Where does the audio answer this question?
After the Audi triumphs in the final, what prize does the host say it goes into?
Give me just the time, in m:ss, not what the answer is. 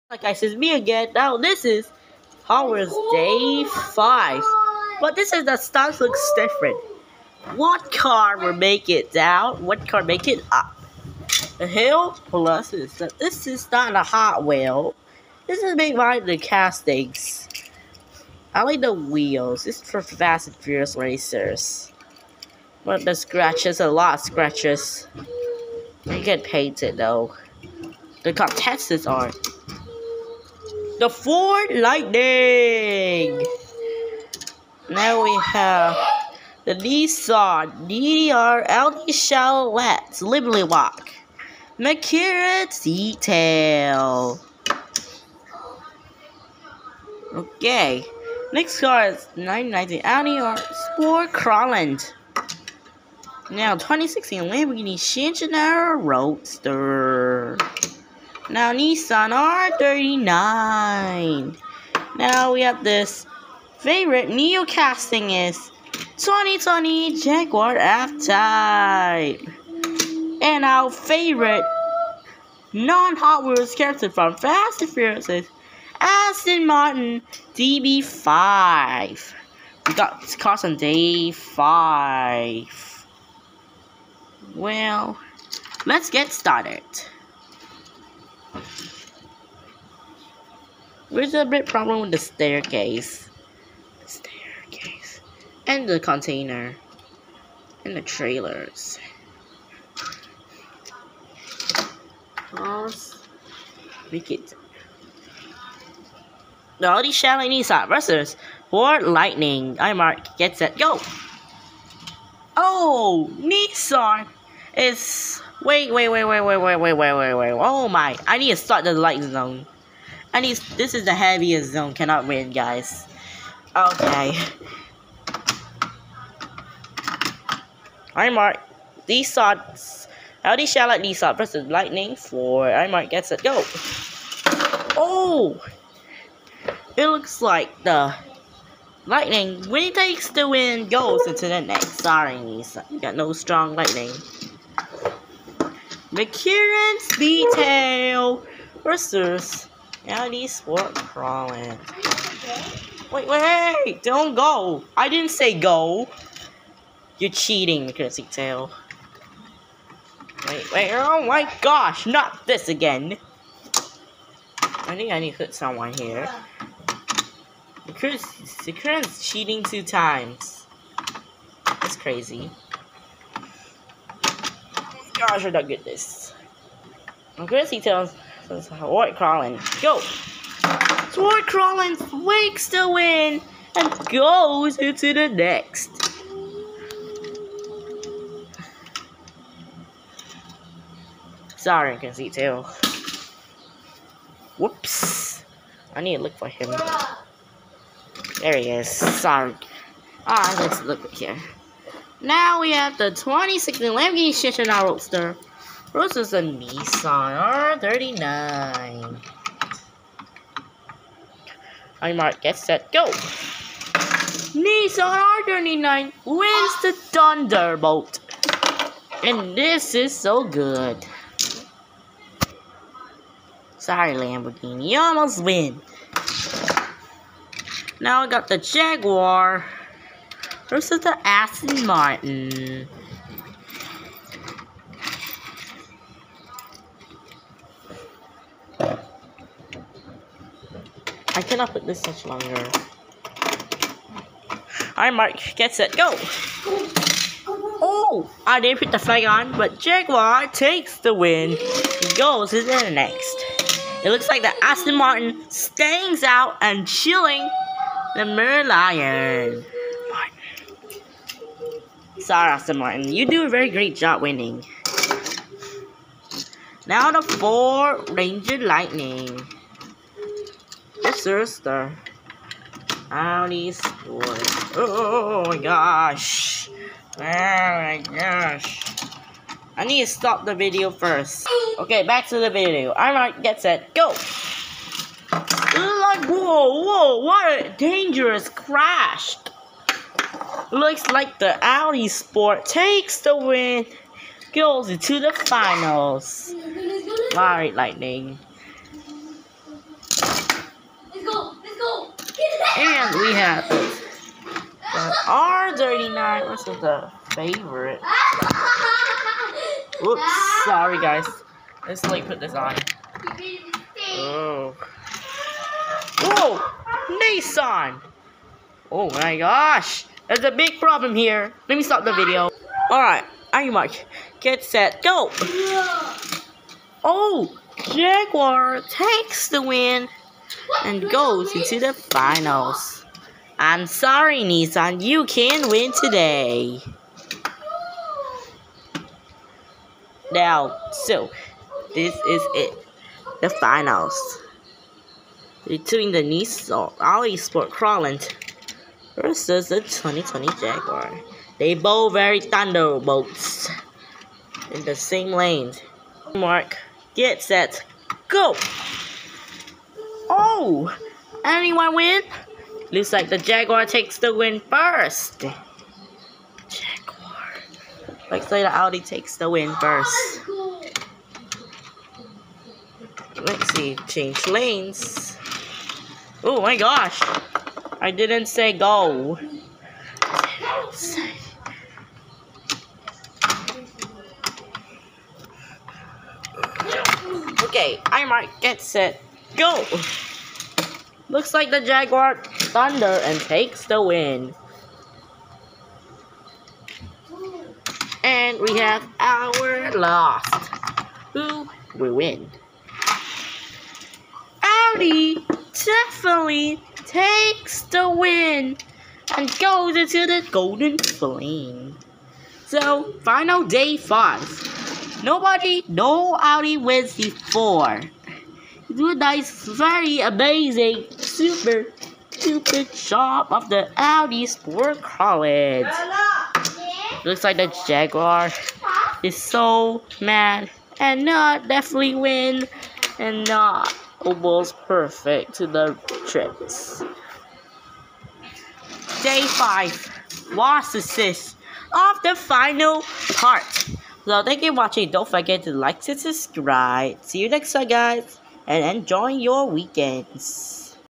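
6:50.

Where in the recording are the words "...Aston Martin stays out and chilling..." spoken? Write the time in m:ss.
4:14.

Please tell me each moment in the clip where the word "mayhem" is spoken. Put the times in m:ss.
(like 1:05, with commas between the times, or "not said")
not said.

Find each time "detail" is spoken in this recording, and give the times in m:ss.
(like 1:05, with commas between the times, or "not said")
0:42, 2:27.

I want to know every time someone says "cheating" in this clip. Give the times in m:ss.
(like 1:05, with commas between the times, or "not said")
2:37, 2:49.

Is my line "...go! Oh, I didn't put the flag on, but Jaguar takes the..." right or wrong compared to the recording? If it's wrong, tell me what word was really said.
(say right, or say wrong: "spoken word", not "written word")
right.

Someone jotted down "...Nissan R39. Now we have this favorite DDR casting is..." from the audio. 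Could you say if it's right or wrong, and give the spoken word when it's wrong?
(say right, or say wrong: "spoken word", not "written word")
wrong: "Neo", not "DDR".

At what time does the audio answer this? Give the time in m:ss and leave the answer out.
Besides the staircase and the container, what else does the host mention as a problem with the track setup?
1:37.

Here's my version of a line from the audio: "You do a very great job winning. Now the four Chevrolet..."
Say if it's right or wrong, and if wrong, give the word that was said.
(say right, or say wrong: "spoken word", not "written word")
wrong: "Ranger", not "Chevrolet".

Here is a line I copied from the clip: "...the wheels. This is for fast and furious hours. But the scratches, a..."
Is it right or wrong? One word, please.
wrong.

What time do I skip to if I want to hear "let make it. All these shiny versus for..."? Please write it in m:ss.
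1:42.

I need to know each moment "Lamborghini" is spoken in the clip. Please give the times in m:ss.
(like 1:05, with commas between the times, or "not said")
0:54, 3:23, 3:44.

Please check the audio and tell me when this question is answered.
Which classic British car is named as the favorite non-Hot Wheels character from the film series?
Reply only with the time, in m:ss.
1:16.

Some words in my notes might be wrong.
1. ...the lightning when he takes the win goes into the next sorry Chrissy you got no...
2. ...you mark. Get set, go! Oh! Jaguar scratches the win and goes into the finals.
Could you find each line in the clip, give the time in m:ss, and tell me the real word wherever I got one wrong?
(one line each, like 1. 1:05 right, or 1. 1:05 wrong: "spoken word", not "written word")
1. 2:17 wrong: "Nisa", not "Chrissy"
2. 5:23 wrong: "takes", not "scratches".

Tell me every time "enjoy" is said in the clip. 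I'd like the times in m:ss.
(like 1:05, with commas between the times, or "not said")
7:28.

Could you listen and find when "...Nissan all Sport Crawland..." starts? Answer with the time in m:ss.
5:46.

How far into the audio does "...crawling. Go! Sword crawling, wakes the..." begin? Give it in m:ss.
2:59.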